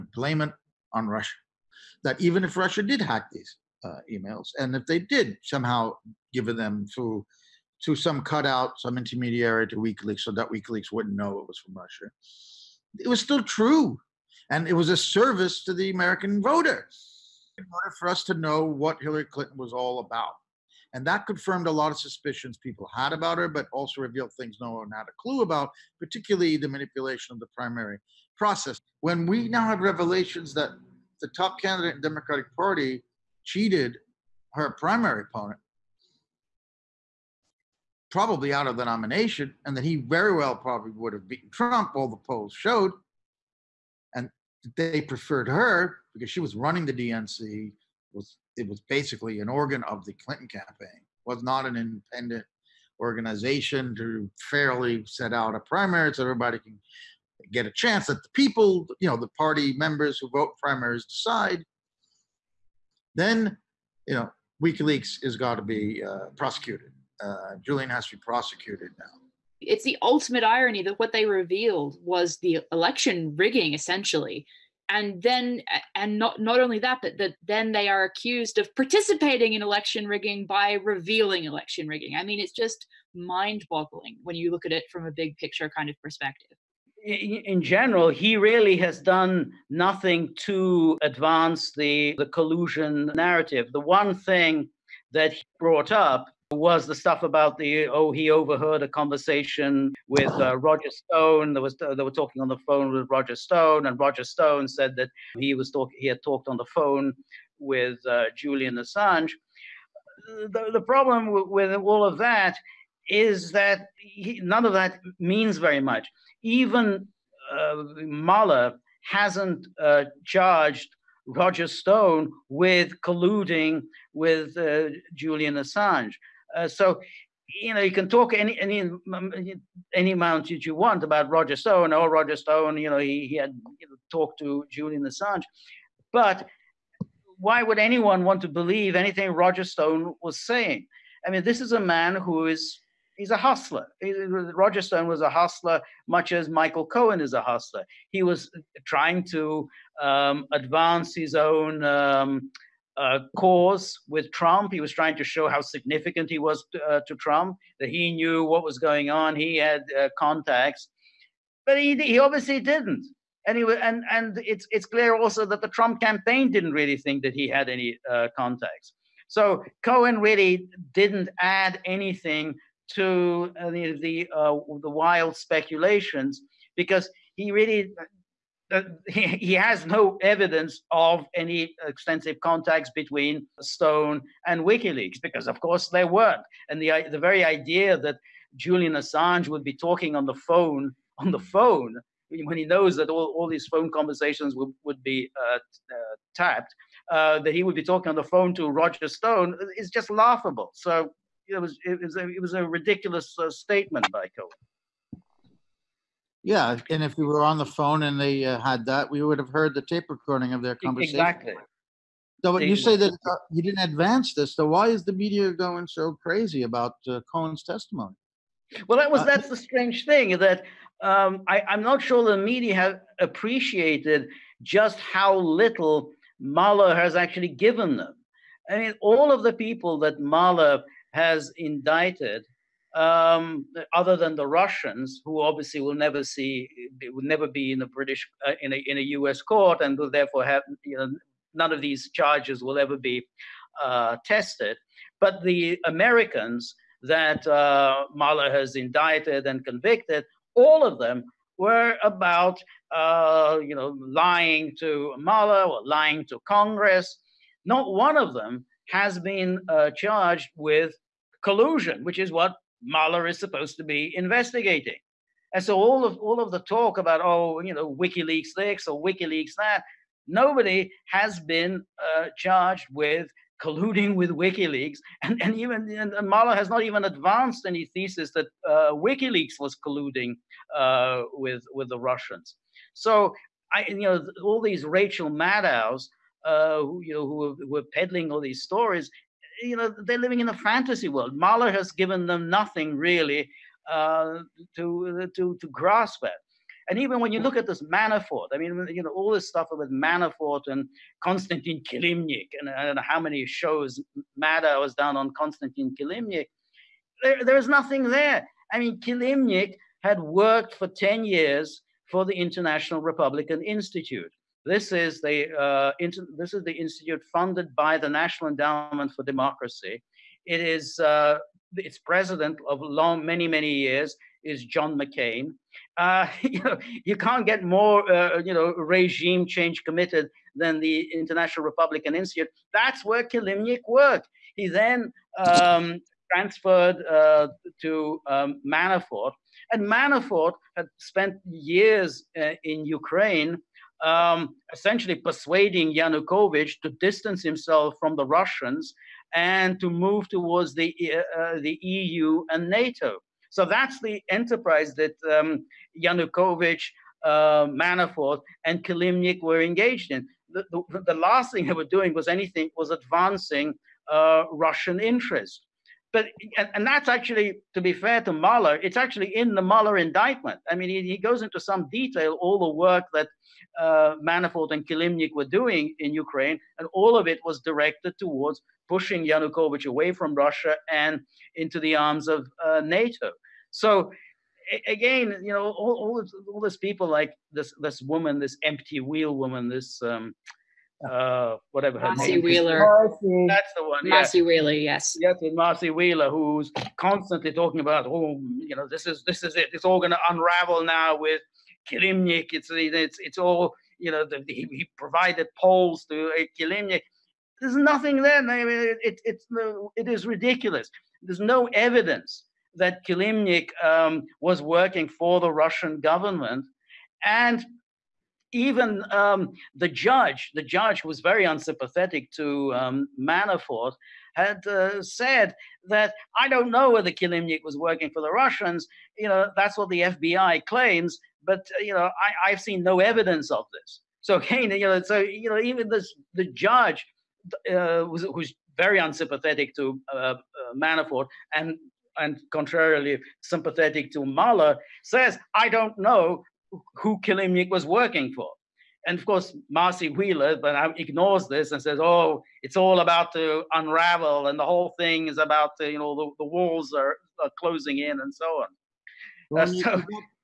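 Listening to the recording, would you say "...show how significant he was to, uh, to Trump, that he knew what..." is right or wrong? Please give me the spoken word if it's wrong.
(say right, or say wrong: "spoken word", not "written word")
right.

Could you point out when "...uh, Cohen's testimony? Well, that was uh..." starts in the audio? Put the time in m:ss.
3:37.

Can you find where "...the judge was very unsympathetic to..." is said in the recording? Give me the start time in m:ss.
7:00.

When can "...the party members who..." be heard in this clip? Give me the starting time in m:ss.
0:59.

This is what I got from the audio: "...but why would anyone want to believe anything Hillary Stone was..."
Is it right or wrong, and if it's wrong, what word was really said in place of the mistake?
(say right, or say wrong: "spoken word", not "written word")
wrong: "Roger", not "Hillary".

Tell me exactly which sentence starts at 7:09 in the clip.
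You know, that's what the FBI claims, but uh, you know, I, have seen no evidence of this.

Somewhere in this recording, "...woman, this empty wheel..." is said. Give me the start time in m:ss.
6:28.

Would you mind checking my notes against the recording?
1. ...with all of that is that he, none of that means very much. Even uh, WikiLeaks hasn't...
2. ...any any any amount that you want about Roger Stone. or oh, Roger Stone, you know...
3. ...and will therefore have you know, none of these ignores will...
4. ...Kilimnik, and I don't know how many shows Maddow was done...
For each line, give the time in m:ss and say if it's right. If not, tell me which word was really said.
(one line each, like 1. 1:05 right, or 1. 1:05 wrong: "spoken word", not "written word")
1. 1:51 wrong: "Mueller", not "WikiLeaks"
2. 2:08 right
3. 3:59 wrong: "charges", not "ignores"
4. 5:01 right.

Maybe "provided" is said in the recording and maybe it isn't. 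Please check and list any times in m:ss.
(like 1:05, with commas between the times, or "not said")
6:44.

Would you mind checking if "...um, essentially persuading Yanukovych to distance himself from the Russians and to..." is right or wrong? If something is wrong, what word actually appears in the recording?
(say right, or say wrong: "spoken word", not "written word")
right.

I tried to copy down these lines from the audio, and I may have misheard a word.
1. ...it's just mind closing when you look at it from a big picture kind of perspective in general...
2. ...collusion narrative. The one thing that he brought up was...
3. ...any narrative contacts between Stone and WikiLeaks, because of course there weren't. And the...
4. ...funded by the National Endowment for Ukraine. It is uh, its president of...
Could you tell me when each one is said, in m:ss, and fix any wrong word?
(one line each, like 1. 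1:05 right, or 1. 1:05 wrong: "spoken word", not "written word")
1. 1:22 wrong: "boggling", not "closing"
2. 1:32 right
3. 3:01 wrong: "extensive", not "narrative"
4. 5:17 wrong: "Democracy", not "Ukraine".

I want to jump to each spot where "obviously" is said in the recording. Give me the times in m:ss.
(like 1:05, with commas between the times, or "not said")
2:42, 3:55.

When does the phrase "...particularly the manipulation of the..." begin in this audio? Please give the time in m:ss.
0:25.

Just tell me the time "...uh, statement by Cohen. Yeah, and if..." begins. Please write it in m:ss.
3:23.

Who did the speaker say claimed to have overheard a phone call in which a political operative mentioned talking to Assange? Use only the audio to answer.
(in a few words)
Michael Cohen.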